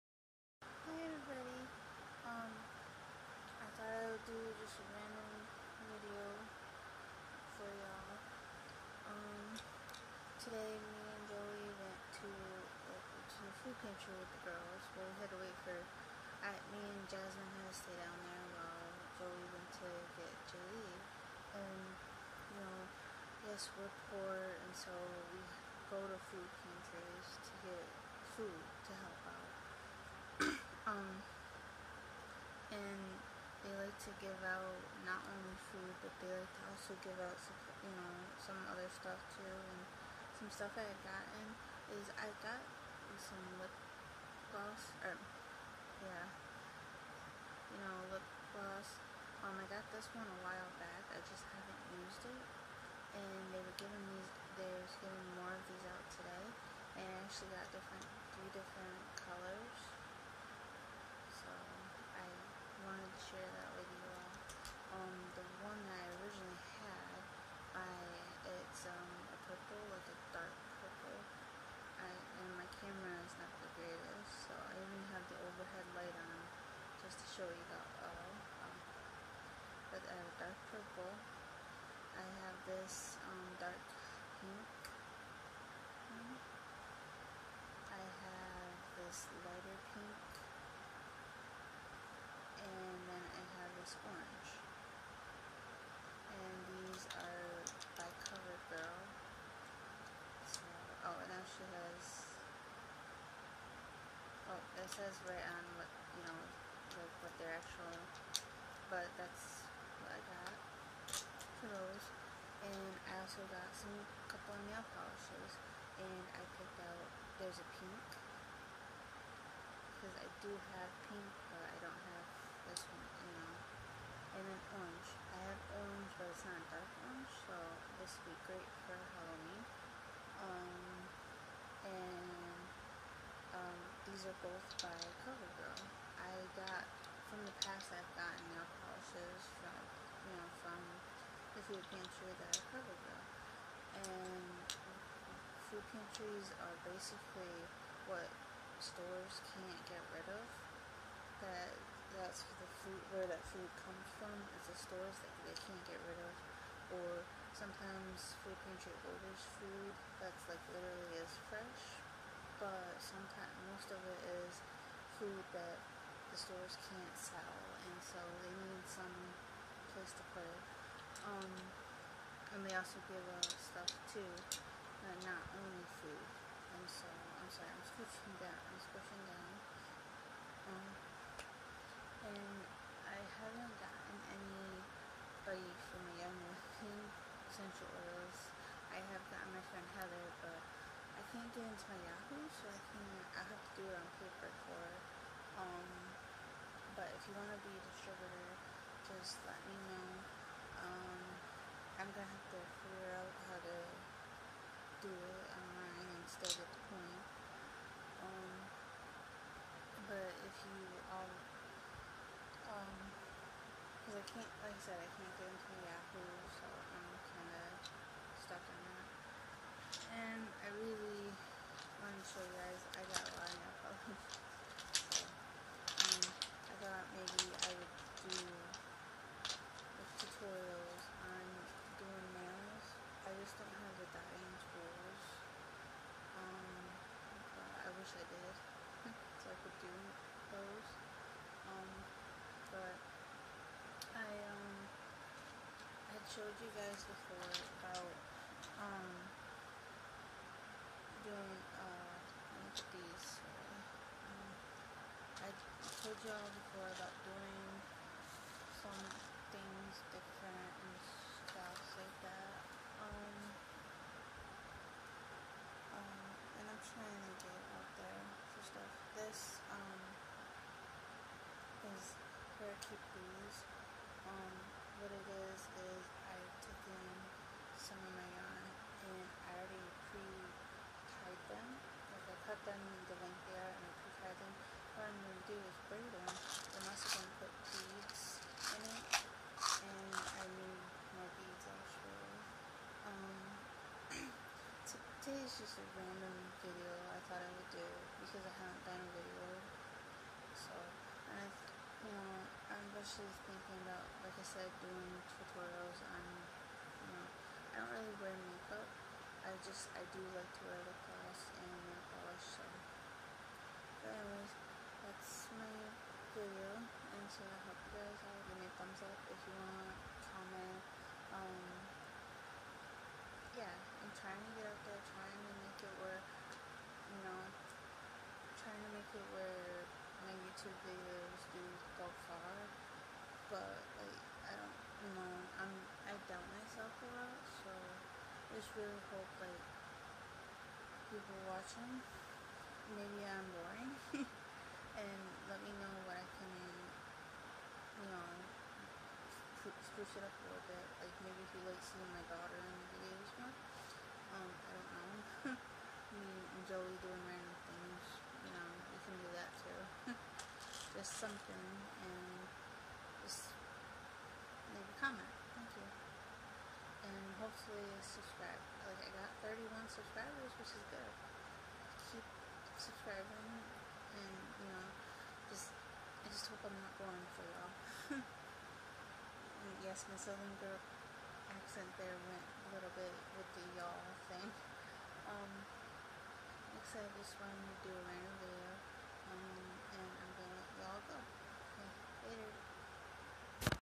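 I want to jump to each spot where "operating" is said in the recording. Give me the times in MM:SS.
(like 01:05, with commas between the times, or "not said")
not said.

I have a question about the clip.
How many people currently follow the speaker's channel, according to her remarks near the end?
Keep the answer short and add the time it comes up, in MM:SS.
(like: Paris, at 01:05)
31, at 06:09.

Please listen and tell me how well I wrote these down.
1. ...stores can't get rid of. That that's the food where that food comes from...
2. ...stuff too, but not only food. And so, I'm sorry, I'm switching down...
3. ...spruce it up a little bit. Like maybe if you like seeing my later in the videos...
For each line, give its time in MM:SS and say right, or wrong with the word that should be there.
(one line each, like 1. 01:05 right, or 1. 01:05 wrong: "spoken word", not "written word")
1. 02:28 right
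2. 02:53 right
3. 05:49 wrong: "daughter", not "later".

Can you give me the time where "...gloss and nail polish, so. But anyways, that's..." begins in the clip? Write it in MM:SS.
05:11.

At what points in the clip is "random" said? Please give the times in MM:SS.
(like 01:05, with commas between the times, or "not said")
04:55, 05:57, 06:28.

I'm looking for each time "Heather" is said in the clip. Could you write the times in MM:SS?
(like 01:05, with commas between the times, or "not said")
03:09.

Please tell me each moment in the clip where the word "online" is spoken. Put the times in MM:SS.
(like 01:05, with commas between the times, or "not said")
03:25.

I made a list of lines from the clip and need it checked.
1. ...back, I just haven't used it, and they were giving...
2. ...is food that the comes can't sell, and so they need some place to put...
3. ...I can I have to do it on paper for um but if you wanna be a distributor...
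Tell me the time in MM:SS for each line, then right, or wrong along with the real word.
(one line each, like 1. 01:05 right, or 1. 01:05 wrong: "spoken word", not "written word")
1. 00:50 right
2. 02:44 wrong: "stores", not "comes"
3. 03:12 right.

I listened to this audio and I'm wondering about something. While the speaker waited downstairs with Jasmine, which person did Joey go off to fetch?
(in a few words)
Julie.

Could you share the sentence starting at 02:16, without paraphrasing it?
I got, from the past I've gotten nail polishes from, you know, from the food pantry that are CoverGirl.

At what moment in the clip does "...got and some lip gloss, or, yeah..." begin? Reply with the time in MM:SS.
00:42.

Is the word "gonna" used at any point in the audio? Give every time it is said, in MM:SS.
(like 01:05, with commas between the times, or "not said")
03:22, 06:30.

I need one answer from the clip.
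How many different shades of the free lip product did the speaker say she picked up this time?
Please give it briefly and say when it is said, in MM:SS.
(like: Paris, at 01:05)
3, at 00:58.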